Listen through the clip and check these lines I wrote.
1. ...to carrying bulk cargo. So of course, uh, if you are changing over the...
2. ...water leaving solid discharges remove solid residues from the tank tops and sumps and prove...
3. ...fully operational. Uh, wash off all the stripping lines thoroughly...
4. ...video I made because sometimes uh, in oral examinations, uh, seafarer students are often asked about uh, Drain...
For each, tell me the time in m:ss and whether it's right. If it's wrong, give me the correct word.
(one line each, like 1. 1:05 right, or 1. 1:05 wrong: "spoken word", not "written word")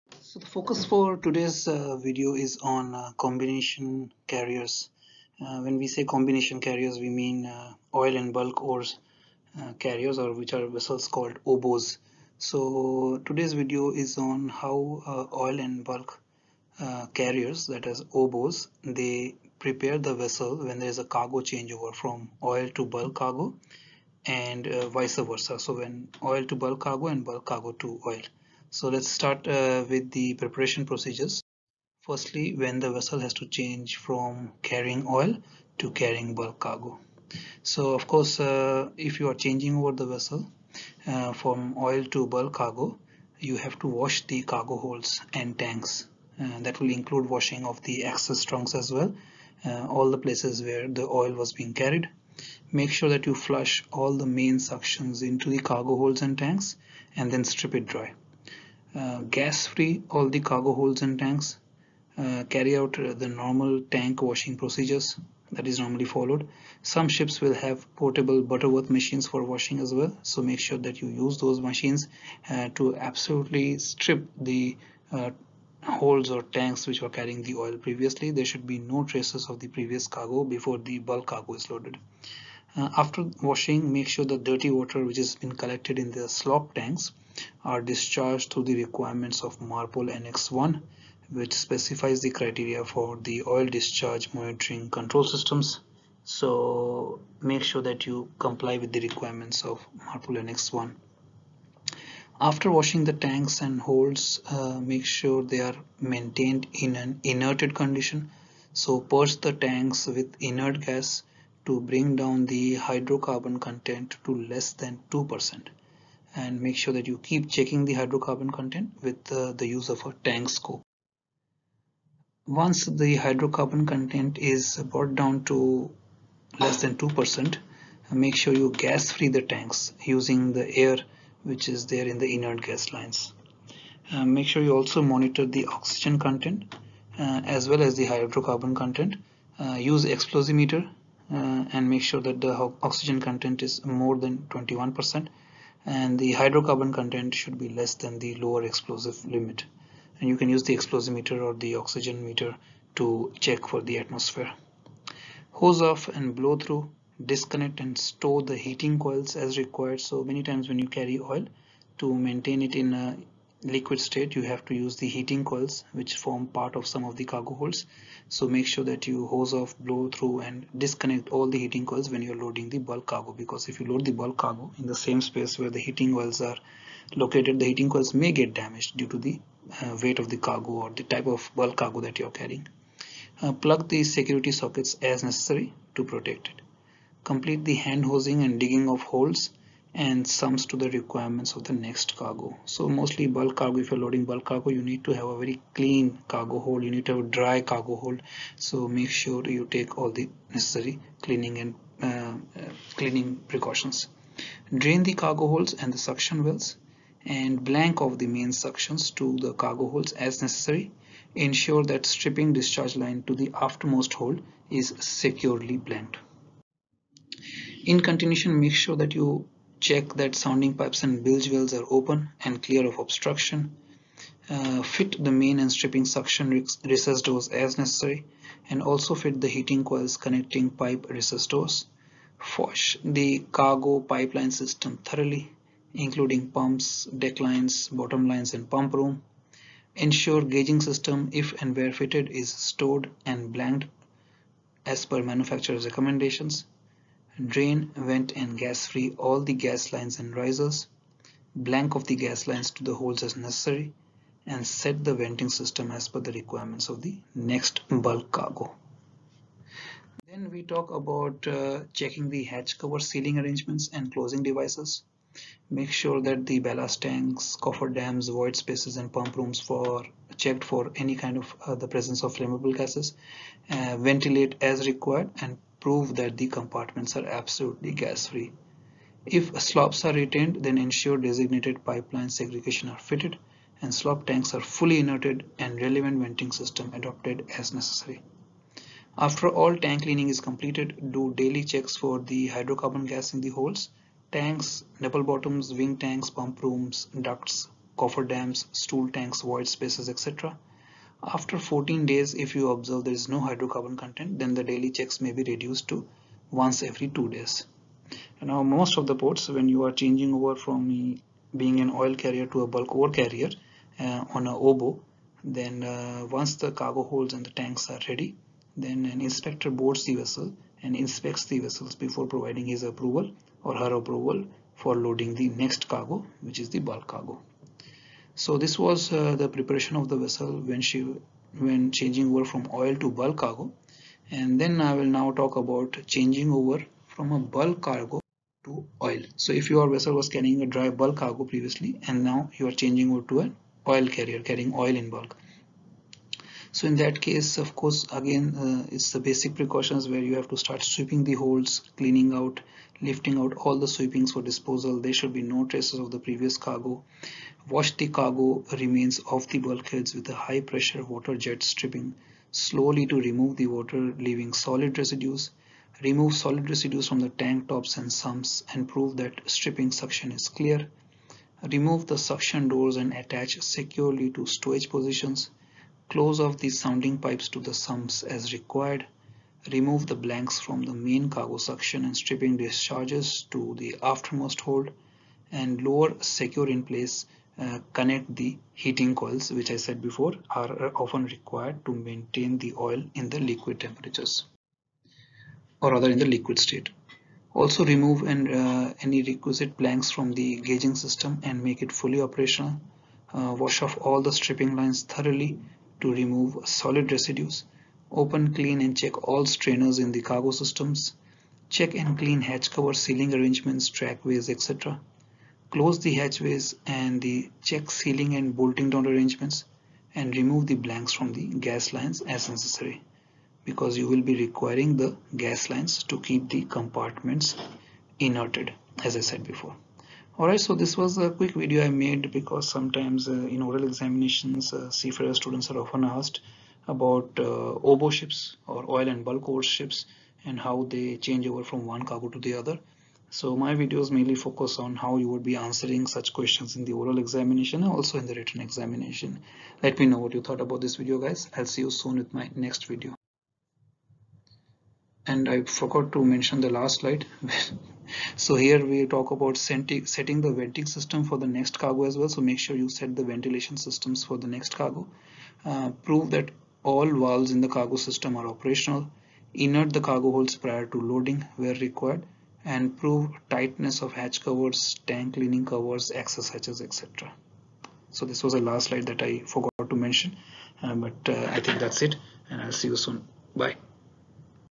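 1. 0:35 right
2. 6:03 wrong: "residues", not "discharges"
3. 6:41 right
4. 7:11 wrong: "OBO", not "Drain".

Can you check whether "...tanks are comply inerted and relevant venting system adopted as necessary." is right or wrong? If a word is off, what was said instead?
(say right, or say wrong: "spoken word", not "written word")
wrong: "fully", not "comply".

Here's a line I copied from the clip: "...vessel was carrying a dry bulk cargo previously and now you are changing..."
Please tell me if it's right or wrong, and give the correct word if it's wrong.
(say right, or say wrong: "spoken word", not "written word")
right.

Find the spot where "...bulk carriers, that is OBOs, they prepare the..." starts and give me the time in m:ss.
0:15.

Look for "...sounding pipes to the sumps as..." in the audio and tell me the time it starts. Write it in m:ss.
6:16.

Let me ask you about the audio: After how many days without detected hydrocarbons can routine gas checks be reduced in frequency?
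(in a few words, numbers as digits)
14.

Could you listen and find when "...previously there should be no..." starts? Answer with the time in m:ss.
1:17.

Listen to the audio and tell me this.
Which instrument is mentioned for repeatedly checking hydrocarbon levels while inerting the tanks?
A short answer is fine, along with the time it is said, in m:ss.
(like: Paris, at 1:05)
Tank scope, at 2:00.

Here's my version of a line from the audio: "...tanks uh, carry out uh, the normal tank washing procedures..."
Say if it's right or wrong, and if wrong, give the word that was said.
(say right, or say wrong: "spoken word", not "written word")
right.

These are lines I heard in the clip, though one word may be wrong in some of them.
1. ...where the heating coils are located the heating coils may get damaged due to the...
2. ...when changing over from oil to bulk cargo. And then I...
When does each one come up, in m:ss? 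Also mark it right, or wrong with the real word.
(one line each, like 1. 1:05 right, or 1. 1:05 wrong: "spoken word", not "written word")
1. 2:55 right
2. 5:31 right.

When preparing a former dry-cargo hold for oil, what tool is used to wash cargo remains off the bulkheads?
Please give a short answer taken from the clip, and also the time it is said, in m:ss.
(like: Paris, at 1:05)
High pressure water jet, at 6:00.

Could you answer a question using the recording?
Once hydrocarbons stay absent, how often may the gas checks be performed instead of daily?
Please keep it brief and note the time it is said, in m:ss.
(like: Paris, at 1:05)
Every two days, at 5:06.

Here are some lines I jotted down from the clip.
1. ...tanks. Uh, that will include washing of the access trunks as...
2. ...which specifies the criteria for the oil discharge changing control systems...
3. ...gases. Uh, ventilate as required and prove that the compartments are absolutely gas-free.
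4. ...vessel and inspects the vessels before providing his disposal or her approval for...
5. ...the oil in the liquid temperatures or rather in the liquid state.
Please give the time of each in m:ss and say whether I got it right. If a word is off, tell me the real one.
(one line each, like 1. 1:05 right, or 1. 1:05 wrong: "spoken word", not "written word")
1. 0:45 right
2. 1:31 wrong: "monitoring", not "changing"
3. 4:32 right
4. 5:20 wrong: "approval", not "disposal"
5. 6:32 right.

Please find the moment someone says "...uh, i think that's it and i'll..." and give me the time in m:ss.
8:01.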